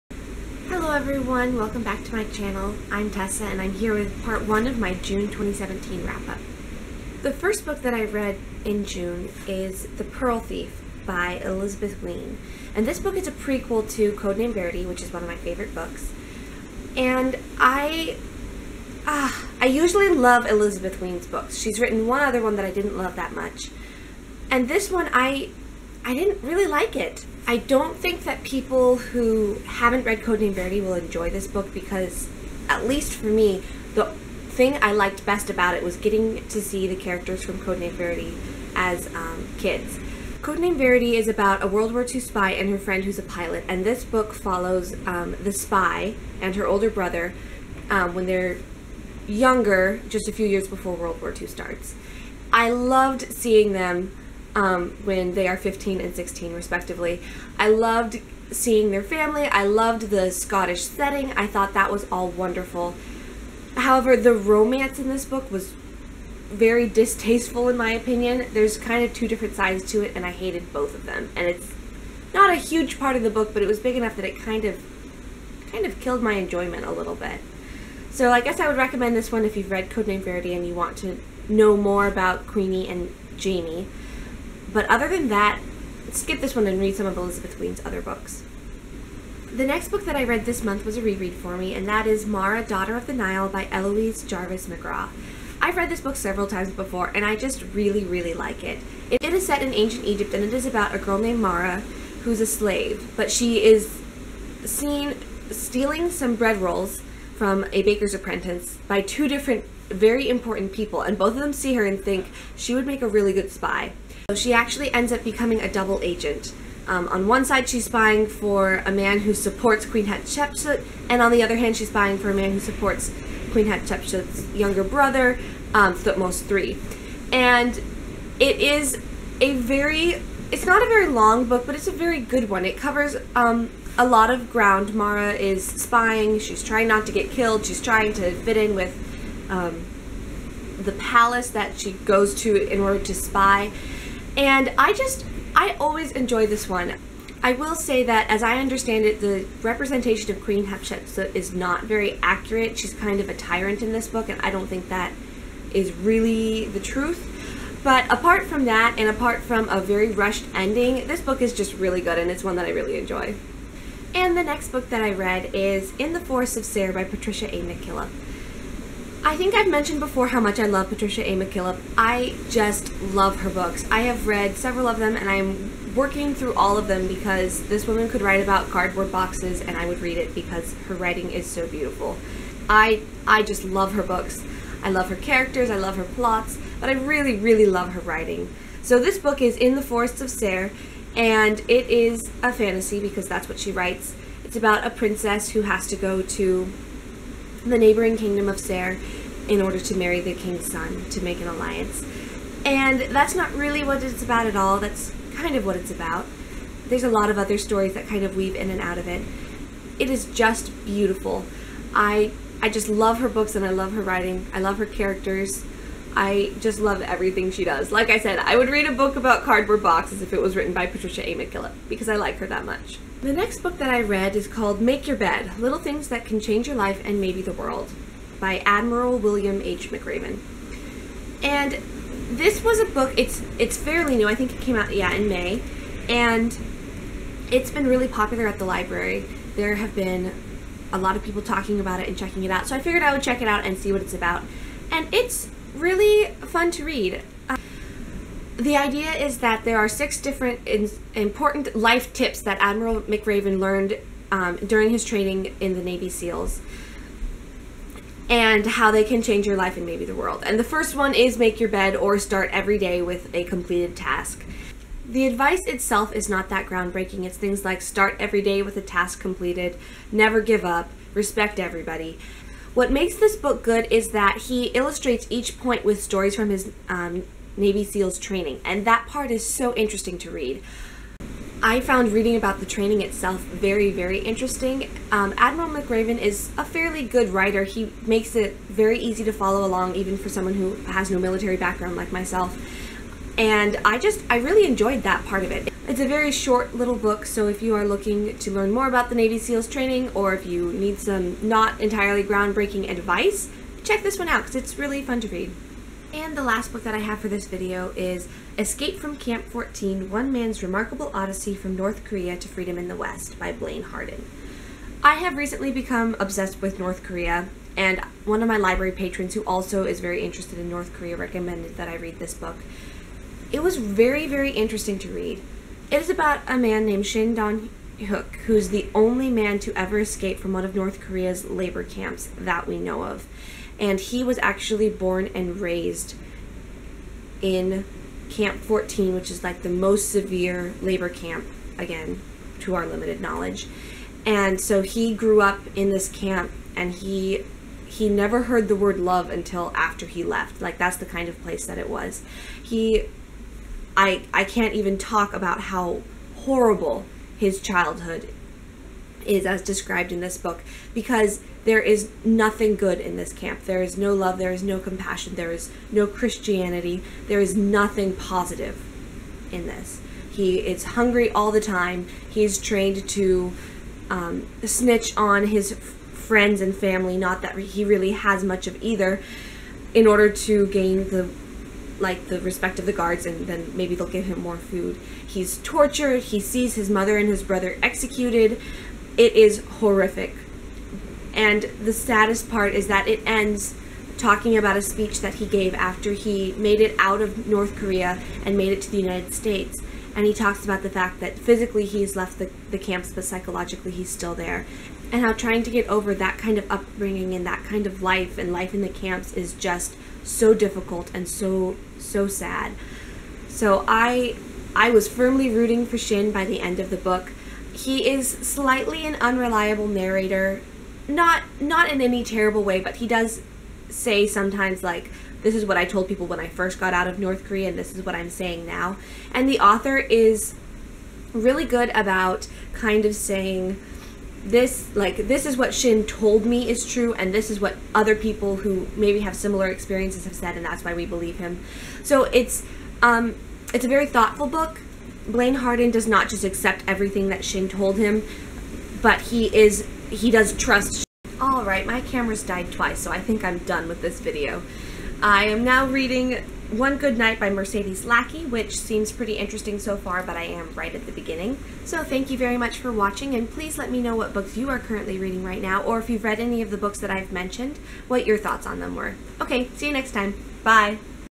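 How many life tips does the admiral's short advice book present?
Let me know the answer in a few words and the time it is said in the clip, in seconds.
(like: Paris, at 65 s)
6, at 249 s.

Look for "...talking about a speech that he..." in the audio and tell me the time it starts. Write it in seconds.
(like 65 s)
394 s.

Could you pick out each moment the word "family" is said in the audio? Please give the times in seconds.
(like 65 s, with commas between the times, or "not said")
59 s, 376 s.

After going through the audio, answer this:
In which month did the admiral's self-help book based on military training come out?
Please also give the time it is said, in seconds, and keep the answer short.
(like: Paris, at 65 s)
May, at 235 s.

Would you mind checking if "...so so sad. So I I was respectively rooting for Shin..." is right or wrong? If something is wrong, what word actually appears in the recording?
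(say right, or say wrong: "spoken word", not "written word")
wrong: "firmly", not "respectively".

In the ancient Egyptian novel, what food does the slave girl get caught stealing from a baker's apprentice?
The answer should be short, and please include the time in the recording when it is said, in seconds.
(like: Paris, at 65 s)
Bread rolls, at 106 s.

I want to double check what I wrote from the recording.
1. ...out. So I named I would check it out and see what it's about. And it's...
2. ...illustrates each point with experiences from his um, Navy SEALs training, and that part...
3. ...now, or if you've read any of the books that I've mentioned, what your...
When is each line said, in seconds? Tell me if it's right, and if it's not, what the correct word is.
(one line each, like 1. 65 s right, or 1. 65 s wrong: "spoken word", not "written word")
1. 242 s wrong: "figured", not "named"
2. 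274 s wrong: "stories", not "experiences"
3. 465 s right.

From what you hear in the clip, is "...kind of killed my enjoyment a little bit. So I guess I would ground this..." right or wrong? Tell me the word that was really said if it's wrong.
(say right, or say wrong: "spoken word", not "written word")
wrong: "recommend", not "ground".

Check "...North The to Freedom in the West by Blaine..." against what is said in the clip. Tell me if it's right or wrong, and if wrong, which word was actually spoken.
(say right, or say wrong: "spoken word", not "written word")
wrong: "Korea", not "The".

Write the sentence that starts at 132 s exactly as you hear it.
It covers um, a lot of ground.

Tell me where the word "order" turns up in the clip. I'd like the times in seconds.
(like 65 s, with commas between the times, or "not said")
142 s, 199 s, 380 s.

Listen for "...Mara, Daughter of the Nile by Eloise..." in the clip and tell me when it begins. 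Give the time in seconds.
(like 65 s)
92 s.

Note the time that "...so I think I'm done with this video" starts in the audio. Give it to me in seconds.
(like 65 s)
452 s.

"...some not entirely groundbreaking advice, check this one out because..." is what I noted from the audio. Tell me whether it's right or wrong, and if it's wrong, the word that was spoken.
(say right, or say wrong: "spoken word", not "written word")
right.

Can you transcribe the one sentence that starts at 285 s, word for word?
Um, Admiral McRaven is a fairly good writer.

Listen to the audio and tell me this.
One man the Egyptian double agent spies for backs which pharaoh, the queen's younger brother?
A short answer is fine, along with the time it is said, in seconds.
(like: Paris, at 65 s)
Thutmose III, at 125 s.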